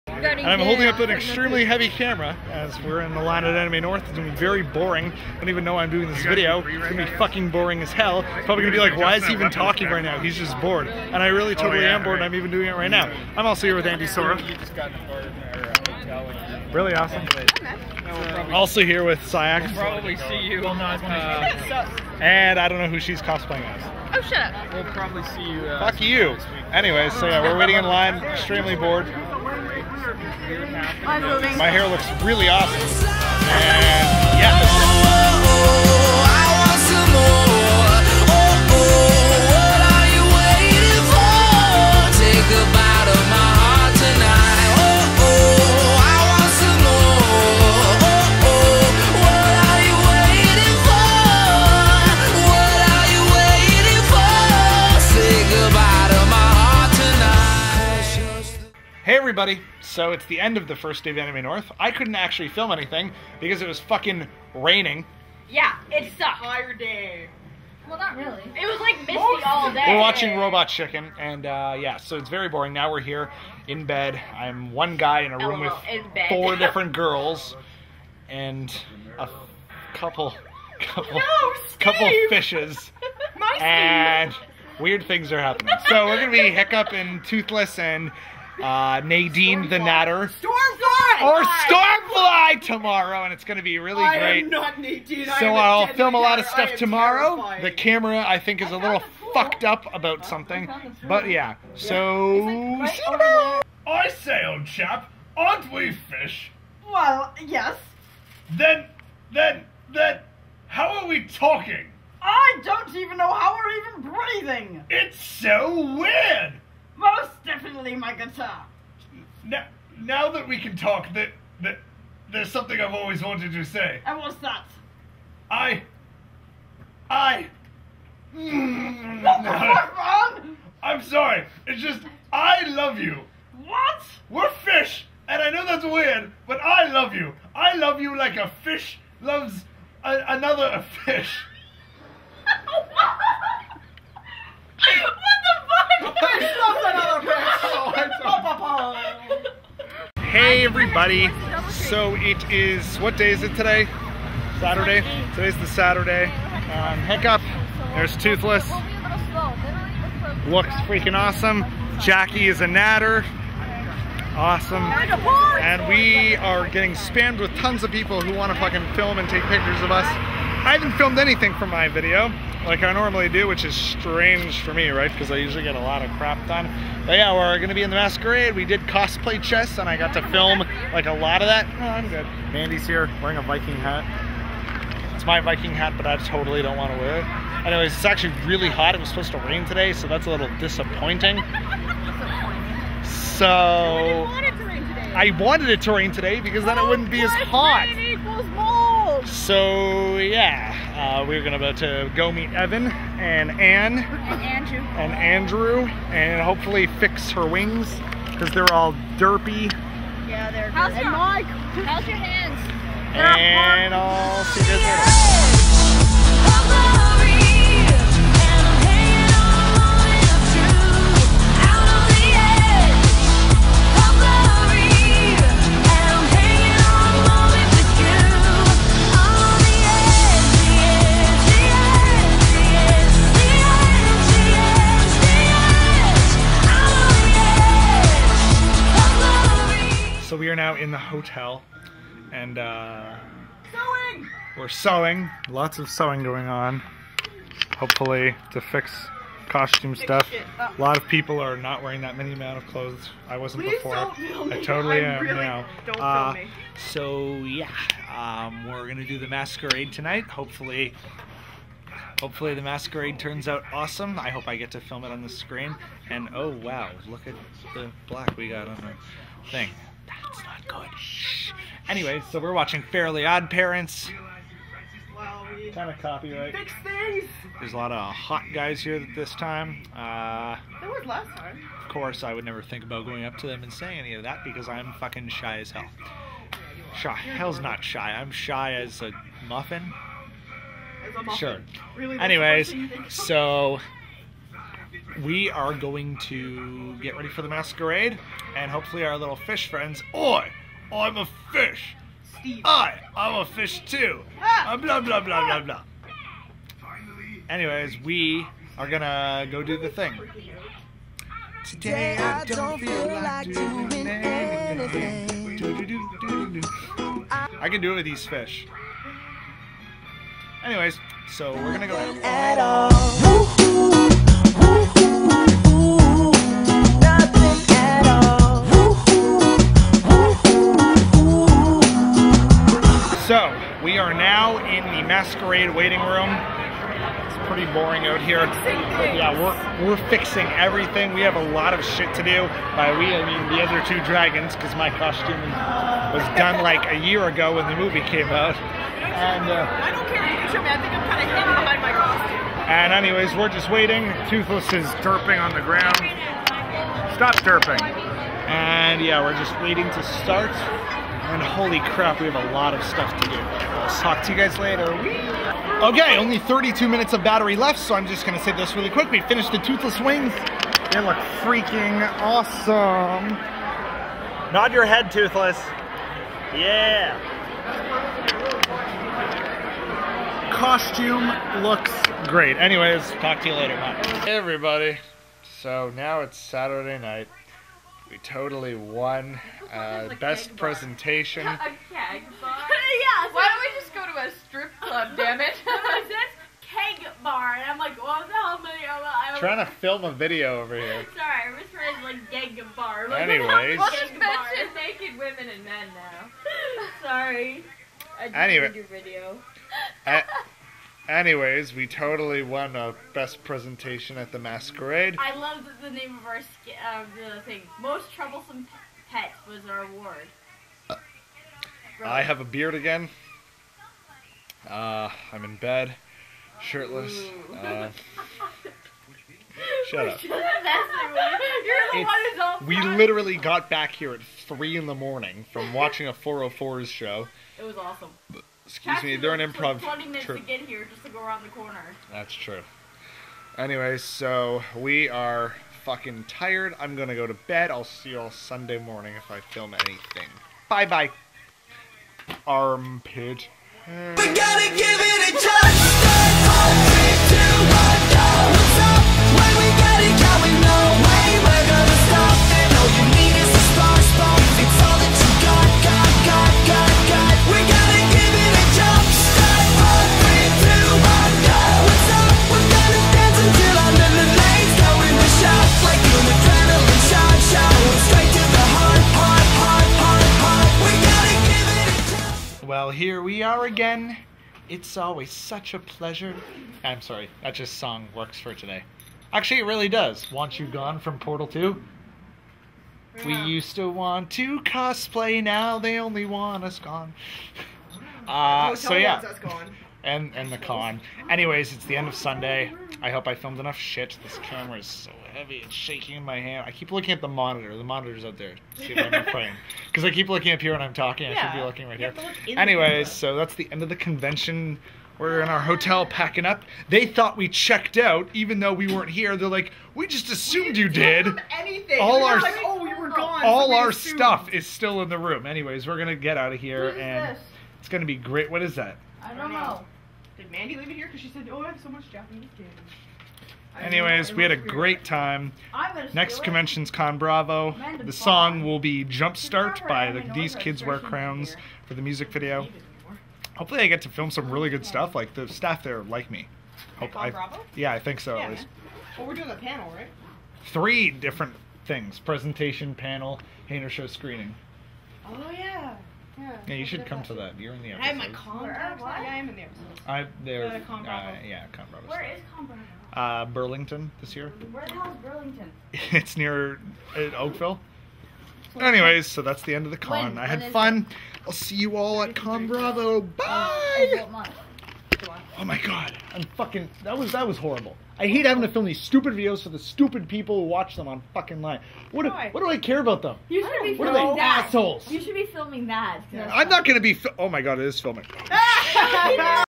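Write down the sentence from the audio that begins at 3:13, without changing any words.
So I wanted it to rain today because then it oh, wouldn't be as hot.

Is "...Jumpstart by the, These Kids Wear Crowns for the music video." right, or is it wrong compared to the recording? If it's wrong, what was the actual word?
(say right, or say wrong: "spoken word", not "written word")
right.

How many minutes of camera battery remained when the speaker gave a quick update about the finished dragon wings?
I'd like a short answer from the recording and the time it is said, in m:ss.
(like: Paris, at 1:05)
32, at 6:06.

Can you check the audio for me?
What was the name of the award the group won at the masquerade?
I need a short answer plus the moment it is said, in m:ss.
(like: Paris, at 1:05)
Most troublesome pet, at 6:57.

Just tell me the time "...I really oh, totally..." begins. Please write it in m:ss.
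0:11.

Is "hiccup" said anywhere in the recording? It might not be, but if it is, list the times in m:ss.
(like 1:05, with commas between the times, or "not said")
1:26, 2:37.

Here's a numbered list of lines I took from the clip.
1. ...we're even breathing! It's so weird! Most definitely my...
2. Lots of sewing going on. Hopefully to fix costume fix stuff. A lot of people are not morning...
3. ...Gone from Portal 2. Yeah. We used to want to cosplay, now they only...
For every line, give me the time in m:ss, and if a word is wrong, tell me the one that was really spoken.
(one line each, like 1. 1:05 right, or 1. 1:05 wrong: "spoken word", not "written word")
1. 1:53 right
2. 4:05 wrong: "wearing", not "morning"
3. 8:10 right.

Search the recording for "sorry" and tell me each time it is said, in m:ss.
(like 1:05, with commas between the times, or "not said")
2:11, 6:41, 6:47, 8:06.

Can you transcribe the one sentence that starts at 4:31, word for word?
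Anyway, so we're watching Fairly Odd Parents.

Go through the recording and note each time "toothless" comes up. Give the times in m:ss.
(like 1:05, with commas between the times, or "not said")
1:27, 2:38, 5:54, 6:09, 6:15.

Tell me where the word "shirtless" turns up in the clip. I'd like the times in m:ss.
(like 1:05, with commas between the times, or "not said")
7:06.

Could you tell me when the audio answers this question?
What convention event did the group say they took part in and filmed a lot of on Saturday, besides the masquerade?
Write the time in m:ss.
2:58.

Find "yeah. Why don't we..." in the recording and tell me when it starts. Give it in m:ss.
6:32.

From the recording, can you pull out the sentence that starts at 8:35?
We're in our hotel packing up.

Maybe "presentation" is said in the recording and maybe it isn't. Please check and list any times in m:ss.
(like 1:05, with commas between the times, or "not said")
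6:30, 6:53, 9:12.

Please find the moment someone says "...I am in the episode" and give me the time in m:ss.
9:19.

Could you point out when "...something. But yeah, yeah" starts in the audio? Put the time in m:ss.
1:40.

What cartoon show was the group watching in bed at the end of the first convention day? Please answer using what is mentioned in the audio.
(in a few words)
Robot Chicken.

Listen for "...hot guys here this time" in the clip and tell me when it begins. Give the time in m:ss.
4:38.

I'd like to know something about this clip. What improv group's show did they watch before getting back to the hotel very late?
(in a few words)
404's.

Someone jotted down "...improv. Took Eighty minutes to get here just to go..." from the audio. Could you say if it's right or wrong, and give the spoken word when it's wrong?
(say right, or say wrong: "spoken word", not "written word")
wrong: "Twenty", not "Eighty".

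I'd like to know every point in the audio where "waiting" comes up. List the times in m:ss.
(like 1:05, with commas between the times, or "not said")
0:27, 5:35, 5:53, 5:59.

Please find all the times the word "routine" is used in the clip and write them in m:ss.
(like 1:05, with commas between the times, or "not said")
not said.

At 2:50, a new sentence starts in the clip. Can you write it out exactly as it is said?
I haven't filmed anything for my video like I normally do, which is strange for me, right?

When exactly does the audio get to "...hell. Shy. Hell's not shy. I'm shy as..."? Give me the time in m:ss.
4:45.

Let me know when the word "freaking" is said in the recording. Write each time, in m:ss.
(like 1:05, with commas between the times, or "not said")
2:40, 6:11.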